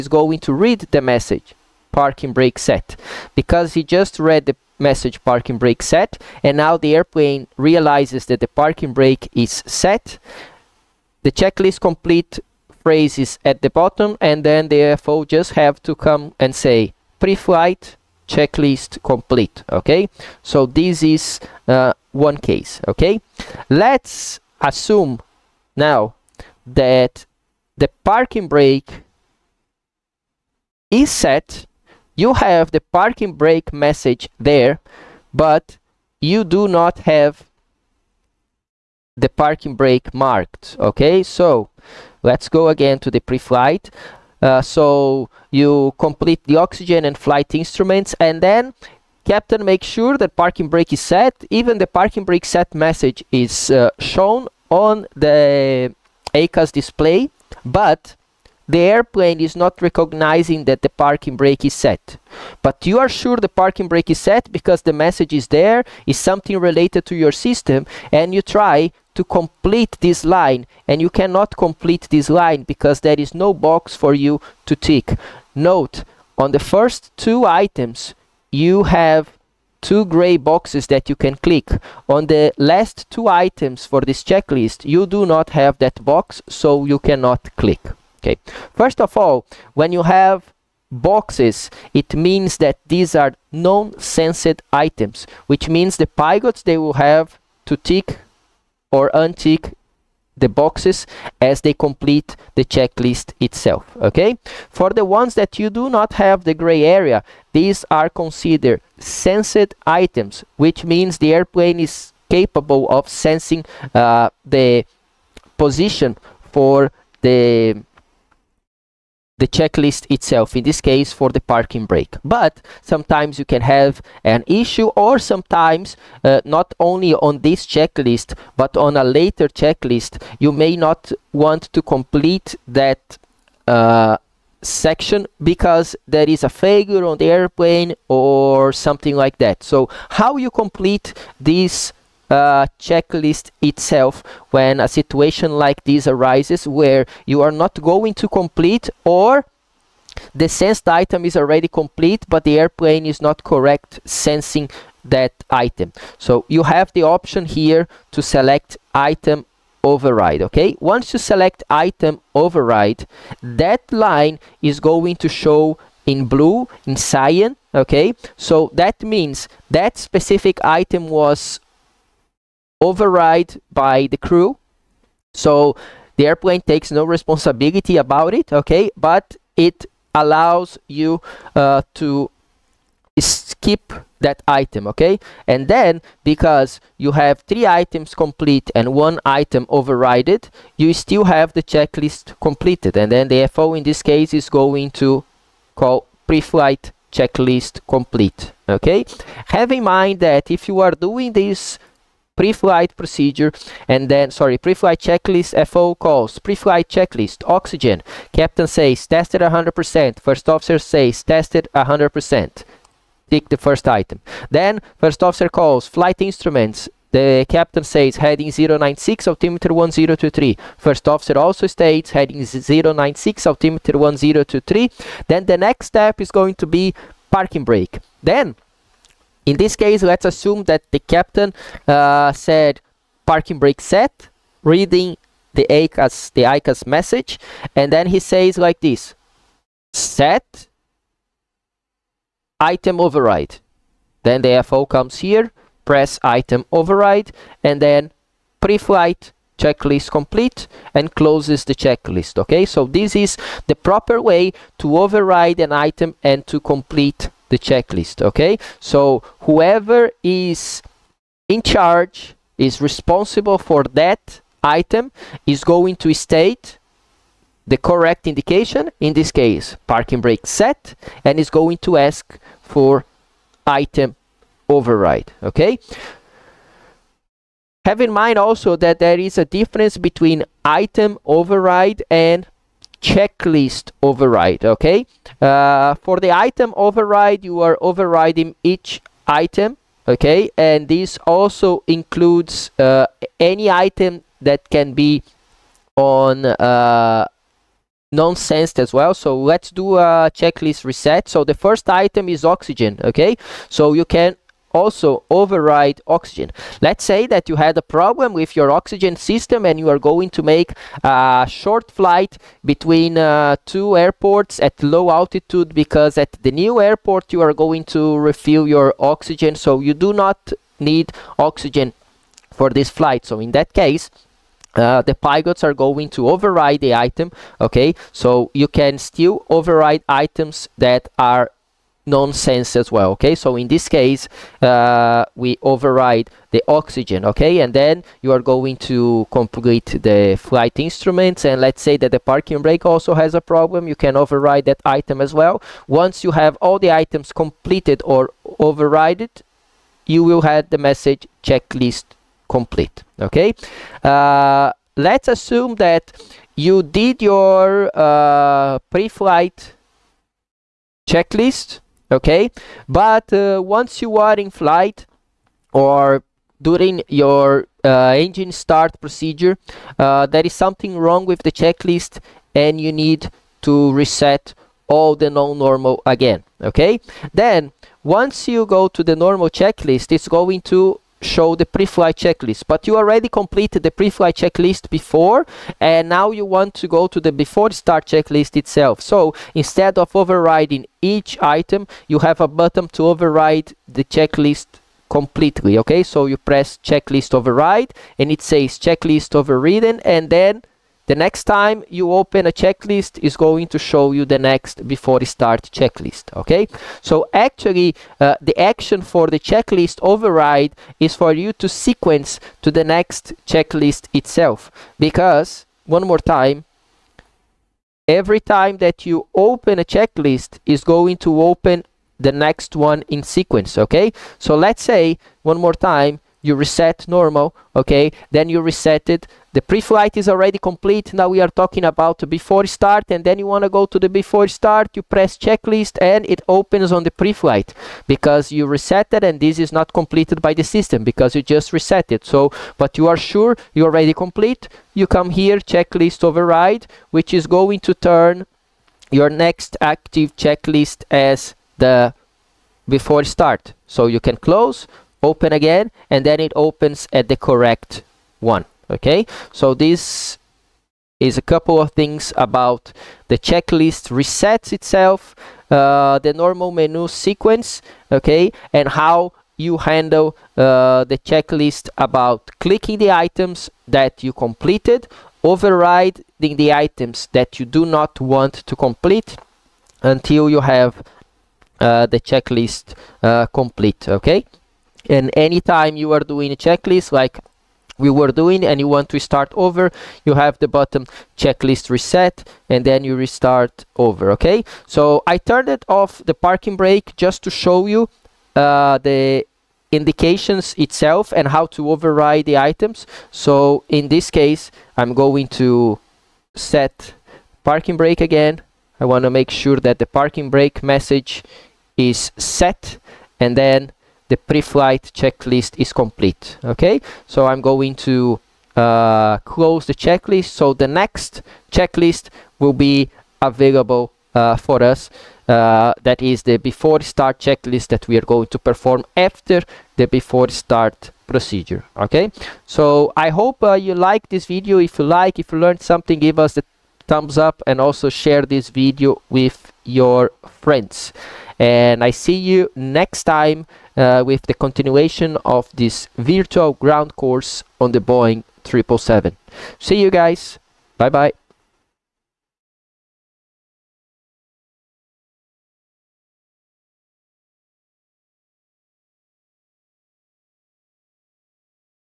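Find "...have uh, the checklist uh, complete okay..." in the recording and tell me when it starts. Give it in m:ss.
8:00.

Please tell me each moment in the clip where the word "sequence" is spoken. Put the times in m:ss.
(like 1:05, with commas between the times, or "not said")
6:51, 7:03, 7:47.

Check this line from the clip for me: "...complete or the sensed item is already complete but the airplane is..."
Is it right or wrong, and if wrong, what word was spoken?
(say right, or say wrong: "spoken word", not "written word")
right.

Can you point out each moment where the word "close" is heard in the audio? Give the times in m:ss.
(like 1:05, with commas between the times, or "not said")
4:11, 7:34, 8:39.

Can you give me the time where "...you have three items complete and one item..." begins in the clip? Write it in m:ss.
3:06.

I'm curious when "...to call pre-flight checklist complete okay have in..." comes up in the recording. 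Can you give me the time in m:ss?
3:14.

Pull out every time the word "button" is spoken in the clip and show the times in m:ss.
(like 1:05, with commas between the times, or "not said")
6:32, 8:10.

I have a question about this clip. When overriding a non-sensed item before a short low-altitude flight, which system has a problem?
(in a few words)
oxygen system.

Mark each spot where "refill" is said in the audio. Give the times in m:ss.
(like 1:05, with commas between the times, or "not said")
5:18.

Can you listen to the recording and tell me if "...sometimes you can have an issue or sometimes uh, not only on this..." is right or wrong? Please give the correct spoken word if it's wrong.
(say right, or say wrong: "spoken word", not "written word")
right.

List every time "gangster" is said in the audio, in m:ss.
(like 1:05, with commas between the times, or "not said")
not said.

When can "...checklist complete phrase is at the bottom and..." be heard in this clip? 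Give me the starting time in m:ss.
0:11.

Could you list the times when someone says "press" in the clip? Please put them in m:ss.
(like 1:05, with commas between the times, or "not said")
4:05, 6:36, 7:15.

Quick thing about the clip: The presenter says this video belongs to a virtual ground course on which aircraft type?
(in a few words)
Boeing 777.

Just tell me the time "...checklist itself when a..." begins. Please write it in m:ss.
2:22.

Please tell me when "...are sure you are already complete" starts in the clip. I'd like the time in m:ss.
7:23.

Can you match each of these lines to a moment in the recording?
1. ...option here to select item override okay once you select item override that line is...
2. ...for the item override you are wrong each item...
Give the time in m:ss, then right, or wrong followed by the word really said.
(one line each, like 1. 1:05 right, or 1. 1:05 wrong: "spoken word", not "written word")
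1. 2:37 right
2. 4:45 wrong: "overriding", not "wrong".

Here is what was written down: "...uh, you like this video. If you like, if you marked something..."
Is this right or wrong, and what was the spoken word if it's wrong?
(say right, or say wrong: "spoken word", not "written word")
wrong: "learned", not "marked".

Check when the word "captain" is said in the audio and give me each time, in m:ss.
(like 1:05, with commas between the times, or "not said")
0:49, 3:28, 3:37, 3:50.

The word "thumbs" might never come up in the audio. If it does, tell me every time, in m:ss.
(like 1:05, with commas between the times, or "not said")
8:57.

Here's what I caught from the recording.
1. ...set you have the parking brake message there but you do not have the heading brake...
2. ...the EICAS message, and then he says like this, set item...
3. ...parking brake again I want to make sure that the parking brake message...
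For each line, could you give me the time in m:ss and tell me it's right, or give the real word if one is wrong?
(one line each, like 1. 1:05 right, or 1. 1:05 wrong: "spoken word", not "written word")
1. 0:31 wrong: "parking", not "heading"
2. 3:56 right
3. 8:27 right.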